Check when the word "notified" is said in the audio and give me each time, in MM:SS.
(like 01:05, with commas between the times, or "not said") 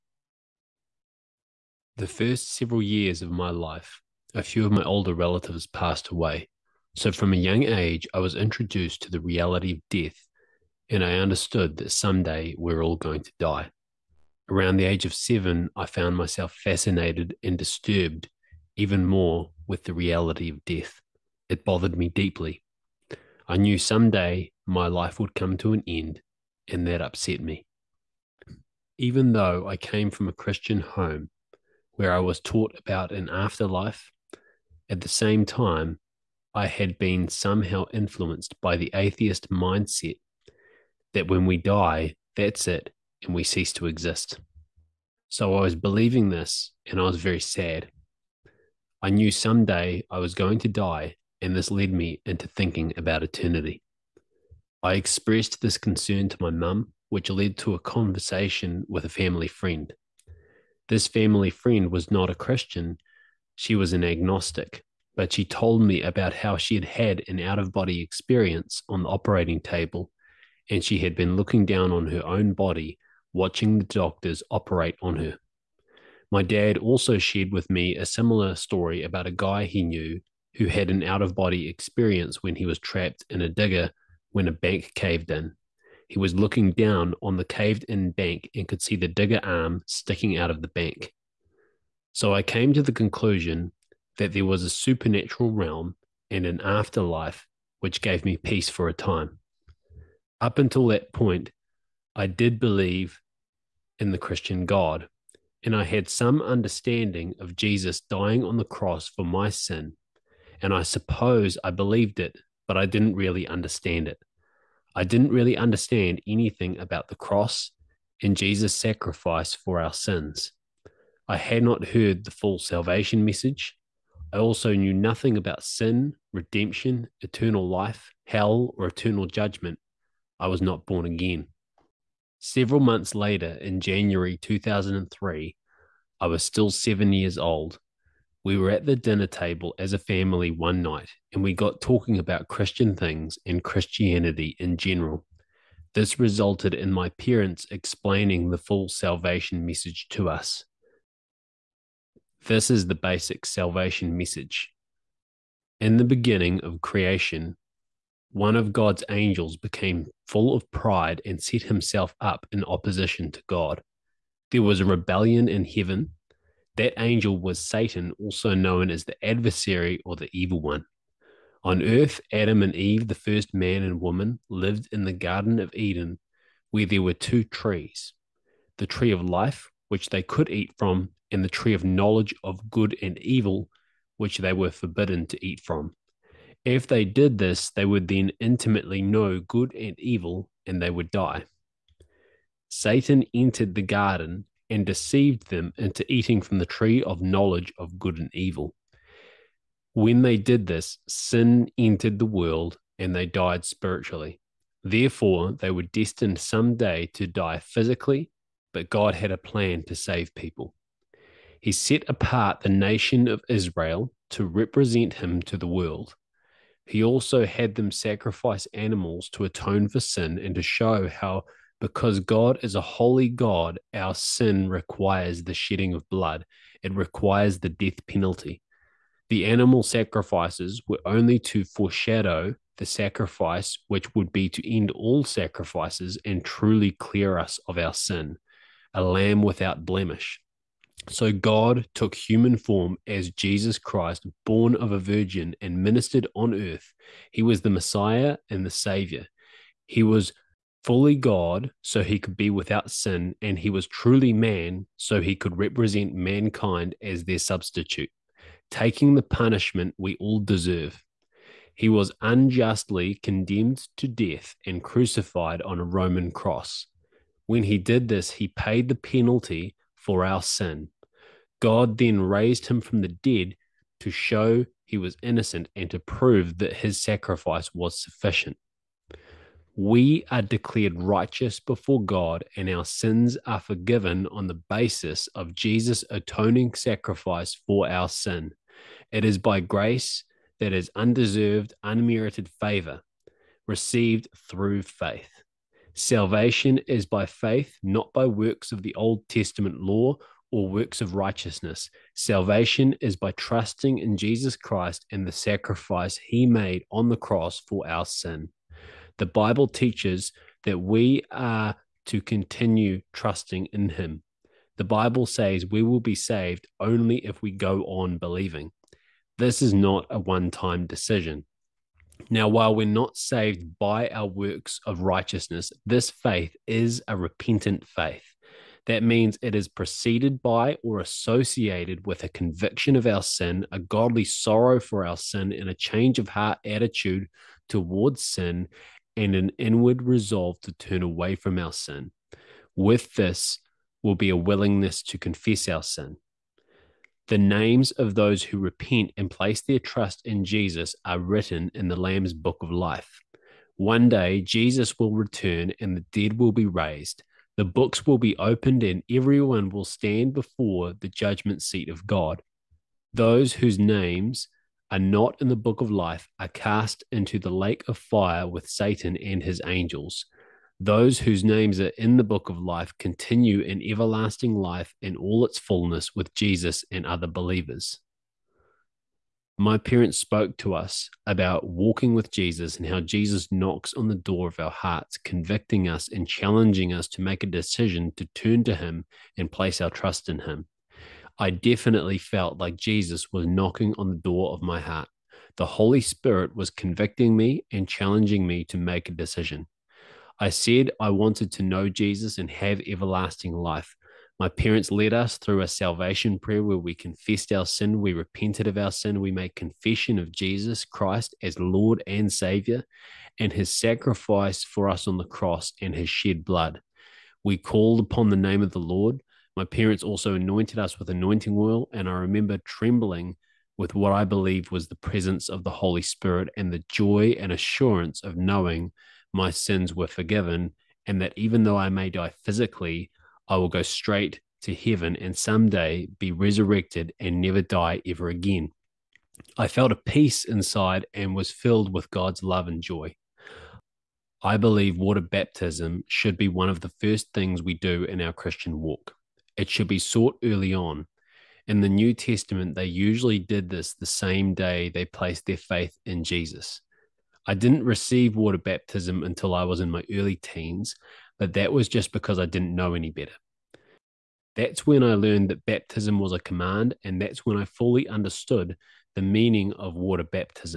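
not said.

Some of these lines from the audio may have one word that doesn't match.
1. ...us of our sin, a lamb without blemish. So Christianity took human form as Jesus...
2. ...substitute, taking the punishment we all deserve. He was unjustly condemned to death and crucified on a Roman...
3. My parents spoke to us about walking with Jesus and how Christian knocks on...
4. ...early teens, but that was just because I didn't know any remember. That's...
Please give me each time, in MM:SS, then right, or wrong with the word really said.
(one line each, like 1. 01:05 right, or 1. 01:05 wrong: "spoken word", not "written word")
1. 03:57 wrong: "God", not "Christianity"
2. 04:17 right
3. 06:19 wrong: "Jesus", not "Christian"
4. 07:40 wrong: "better", not "remember".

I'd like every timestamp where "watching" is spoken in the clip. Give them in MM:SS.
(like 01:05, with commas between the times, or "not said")
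01:13.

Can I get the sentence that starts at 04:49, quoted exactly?
It is by grace that is undeserved, unmerited favor received through faith.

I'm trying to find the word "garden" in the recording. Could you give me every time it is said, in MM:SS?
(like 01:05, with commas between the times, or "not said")
02:55, 03:13.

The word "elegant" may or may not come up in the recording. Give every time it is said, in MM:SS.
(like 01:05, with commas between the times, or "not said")
not said.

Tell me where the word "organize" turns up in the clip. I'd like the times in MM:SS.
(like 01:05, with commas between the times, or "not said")
not said.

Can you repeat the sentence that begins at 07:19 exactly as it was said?
I felt a peace inside and was filled with God's love and joy.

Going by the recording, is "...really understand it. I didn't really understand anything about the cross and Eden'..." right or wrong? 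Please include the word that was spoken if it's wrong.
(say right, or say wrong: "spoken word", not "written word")
wrong: "Jesus", not "Eden".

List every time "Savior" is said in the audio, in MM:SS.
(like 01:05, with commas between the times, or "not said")
04:08, 06:52.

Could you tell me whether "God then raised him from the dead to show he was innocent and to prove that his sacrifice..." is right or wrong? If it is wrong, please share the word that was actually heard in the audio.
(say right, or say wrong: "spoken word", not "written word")
right.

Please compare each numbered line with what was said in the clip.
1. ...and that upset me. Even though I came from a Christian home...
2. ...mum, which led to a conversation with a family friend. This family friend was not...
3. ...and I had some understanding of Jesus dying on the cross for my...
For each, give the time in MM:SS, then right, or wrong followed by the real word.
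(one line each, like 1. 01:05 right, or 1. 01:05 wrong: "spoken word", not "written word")
1. 00:26 right
2. 00:56 right
3. 01:45 right.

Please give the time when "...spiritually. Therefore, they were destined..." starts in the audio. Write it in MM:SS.
03:23.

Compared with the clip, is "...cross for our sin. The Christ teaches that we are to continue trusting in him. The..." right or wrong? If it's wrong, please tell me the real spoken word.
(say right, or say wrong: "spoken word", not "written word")
wrong: "Bible", not "Christ".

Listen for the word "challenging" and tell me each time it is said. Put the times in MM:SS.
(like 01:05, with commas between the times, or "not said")
06:26, 06:37.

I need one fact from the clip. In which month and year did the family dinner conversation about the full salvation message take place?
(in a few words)
January 2003.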